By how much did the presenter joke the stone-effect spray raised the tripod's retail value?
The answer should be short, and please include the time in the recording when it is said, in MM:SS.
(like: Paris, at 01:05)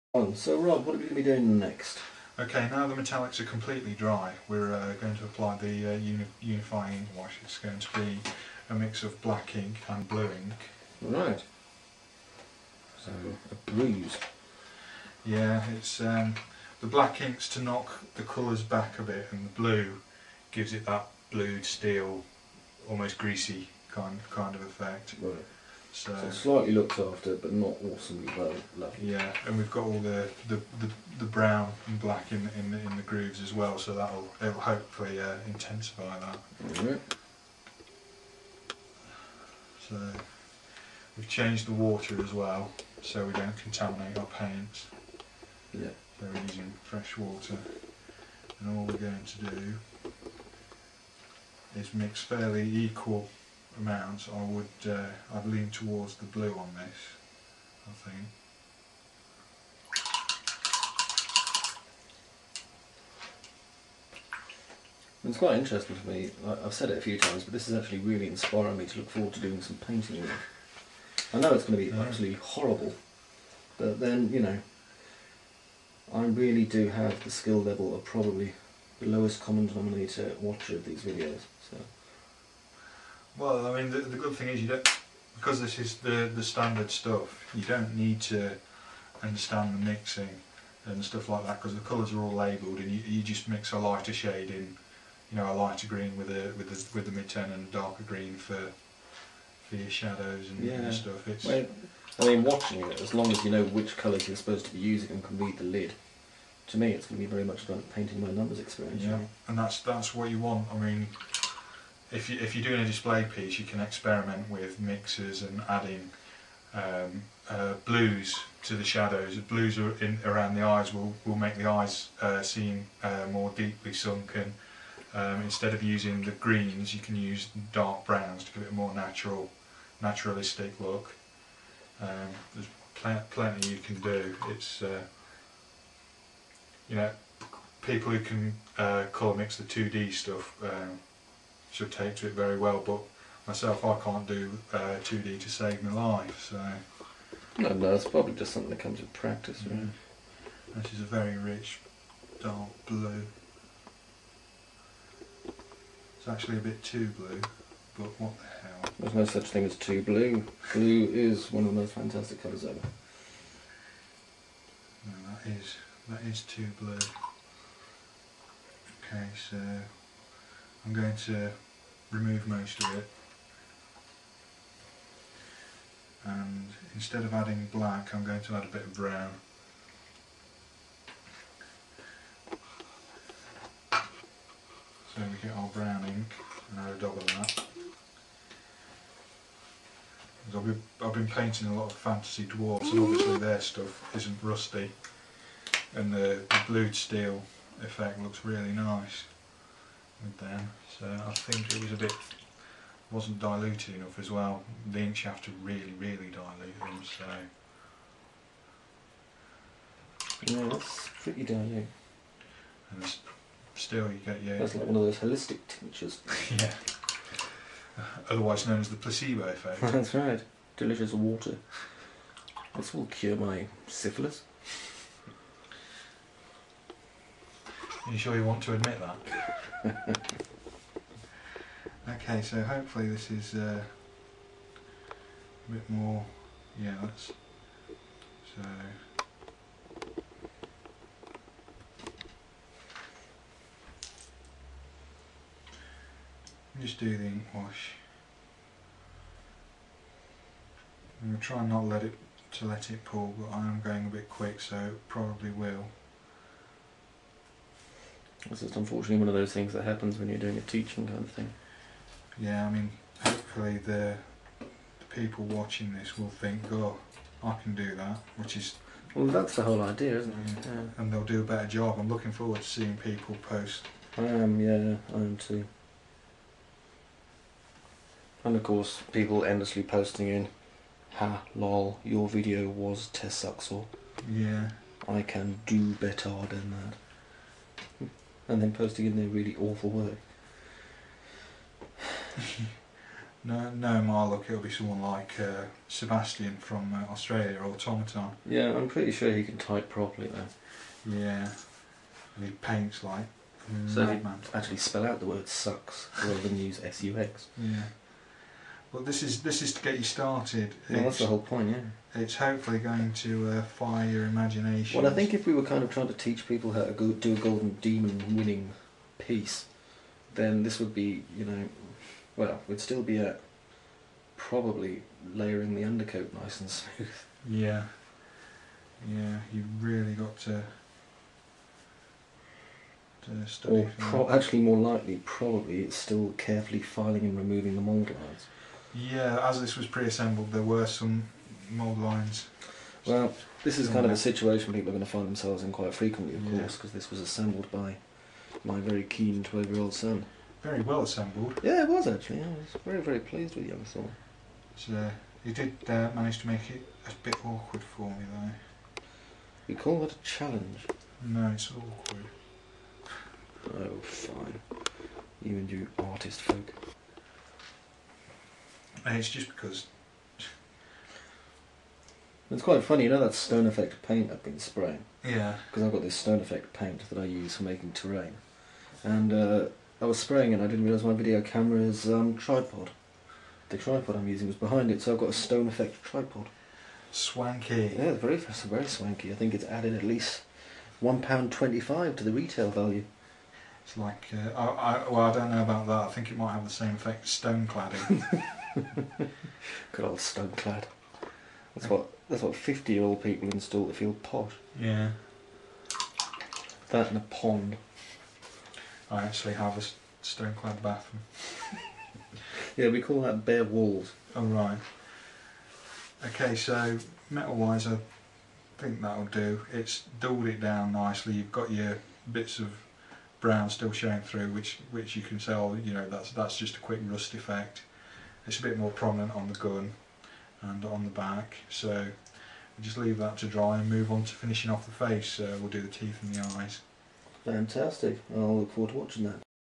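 £1.25, at 06:31.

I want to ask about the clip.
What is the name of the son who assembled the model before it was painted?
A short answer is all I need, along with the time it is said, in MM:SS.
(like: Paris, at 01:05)
Saul, at 05:53.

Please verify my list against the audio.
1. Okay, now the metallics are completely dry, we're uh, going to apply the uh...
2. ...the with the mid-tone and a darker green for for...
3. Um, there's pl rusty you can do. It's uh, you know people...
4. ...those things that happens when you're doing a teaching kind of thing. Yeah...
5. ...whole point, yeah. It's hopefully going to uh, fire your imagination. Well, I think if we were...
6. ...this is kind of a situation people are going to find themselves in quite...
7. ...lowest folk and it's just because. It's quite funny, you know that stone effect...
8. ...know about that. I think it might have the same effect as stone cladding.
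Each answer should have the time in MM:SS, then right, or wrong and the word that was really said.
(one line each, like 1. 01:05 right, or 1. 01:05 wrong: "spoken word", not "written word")
1. 00:02 right
2. 01:36 right
3. 02:12 wrong: "plenty", not "rusty"
4. 04:19 right
5. 05:11 right
6. 05:43 right
7. 06:05 wrong: "artist", not "lowest"
8. 06:35 right.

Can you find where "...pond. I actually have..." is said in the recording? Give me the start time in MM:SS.
06:47.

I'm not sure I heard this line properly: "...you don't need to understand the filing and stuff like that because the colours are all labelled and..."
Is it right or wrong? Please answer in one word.
wrong.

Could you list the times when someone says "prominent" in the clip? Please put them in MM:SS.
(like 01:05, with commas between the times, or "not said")
07:08.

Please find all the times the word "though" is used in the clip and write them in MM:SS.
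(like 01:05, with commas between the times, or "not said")
05:00, 05:58.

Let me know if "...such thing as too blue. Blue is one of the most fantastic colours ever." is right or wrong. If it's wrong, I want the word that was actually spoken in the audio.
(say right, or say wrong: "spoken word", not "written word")
right.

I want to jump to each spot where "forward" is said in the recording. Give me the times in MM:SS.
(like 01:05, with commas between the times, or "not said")
01:09, 04:32, 07:18.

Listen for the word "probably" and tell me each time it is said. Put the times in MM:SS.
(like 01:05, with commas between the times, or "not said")
01:18, 02:28, 04:15, 05:24, 05:35.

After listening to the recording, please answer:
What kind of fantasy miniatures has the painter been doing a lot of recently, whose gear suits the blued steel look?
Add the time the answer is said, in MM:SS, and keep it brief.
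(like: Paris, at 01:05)
Dwarfs, at 03:11.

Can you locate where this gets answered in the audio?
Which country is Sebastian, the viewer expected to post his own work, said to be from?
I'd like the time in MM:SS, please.
04:57.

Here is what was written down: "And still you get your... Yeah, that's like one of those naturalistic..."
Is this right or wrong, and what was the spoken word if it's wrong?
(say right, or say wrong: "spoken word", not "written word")
wrong: "holistic", not "naturalistic".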